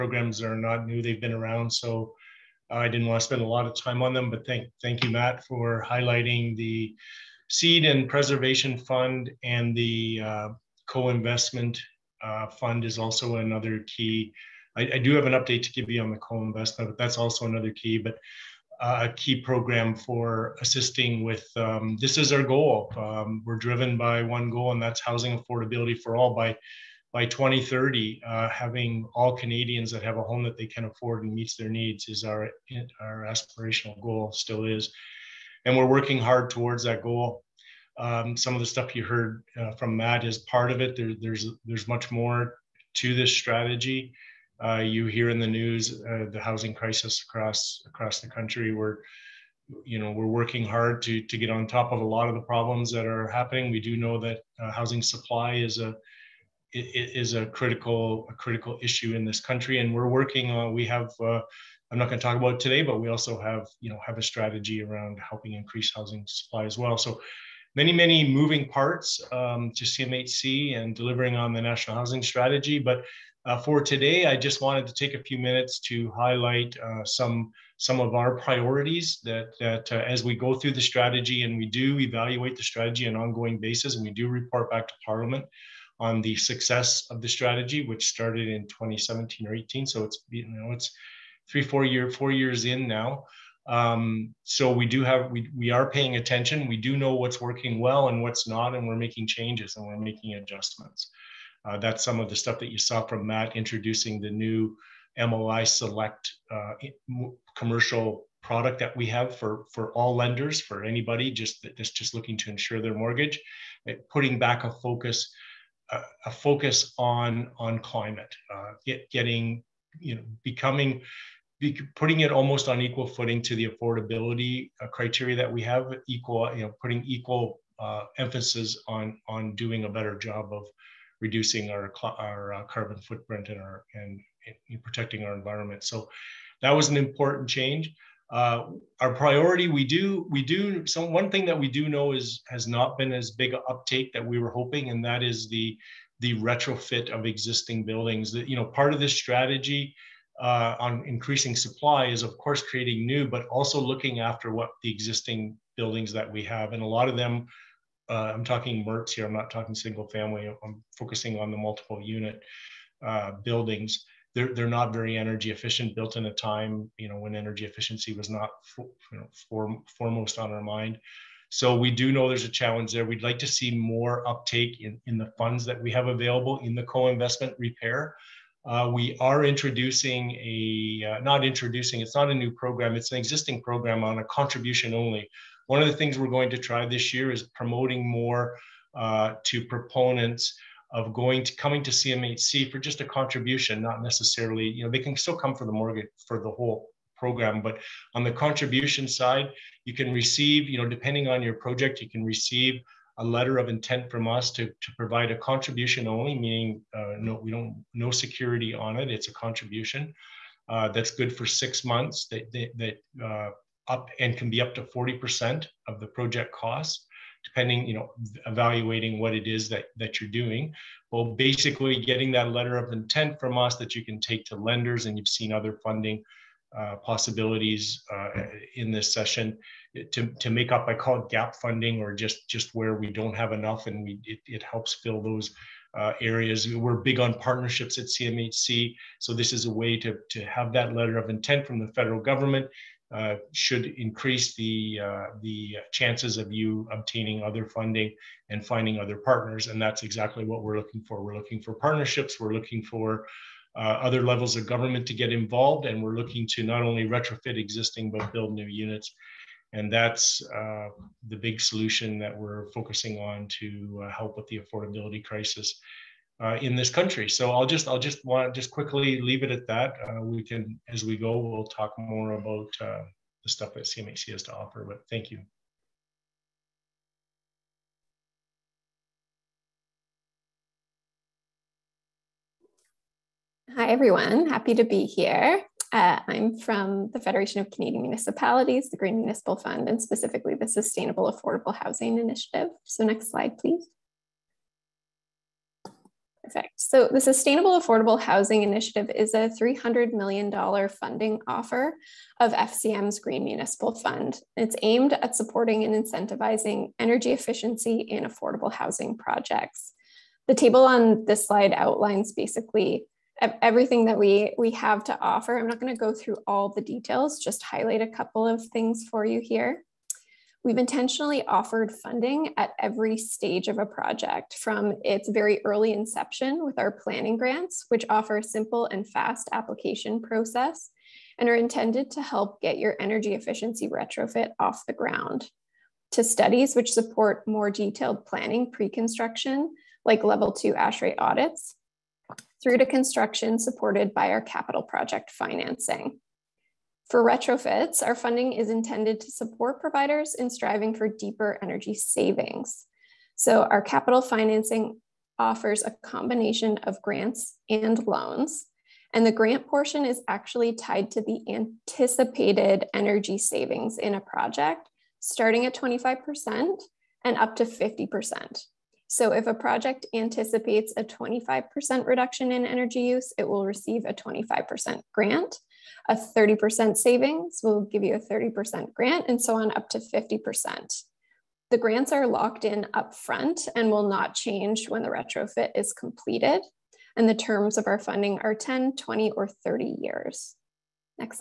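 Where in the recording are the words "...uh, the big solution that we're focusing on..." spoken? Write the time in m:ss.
4:20.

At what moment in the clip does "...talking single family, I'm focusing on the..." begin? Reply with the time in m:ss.
2:39.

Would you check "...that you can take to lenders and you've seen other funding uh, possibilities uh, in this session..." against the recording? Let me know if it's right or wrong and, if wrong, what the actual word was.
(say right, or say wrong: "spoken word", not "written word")
right.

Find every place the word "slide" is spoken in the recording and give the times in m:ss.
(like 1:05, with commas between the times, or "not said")
4:53, 5:11.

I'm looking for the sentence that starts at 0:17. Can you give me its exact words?
But uh, a key program for assisting with um, this is our goal.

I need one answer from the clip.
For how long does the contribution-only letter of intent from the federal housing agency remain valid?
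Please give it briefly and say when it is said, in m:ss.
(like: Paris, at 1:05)
six months, at 3:31.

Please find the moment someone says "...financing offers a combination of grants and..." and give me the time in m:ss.
5:54.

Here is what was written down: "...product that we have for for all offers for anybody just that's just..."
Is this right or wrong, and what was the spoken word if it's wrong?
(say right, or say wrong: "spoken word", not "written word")
wrong: "lenders", not "offers".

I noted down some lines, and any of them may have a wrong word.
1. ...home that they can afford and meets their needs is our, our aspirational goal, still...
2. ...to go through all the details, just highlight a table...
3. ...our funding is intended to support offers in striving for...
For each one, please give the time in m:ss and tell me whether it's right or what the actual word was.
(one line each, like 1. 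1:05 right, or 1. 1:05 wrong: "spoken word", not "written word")
1. 0:30 right
2. 5:15 wrong: "couple", not "table"
3. 5:48 wrong: "providers", not "offers".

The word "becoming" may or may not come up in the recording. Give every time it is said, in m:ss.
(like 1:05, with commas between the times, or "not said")
2:00.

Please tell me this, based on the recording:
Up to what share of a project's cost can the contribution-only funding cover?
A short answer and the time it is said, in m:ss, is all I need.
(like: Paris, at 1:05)
40%, at 3:34.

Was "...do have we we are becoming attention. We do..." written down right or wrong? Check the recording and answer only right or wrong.
wrong.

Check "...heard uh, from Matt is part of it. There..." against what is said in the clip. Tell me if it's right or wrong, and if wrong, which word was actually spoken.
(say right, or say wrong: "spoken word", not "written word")
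right.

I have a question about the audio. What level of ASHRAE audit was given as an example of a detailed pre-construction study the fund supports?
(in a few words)
level two.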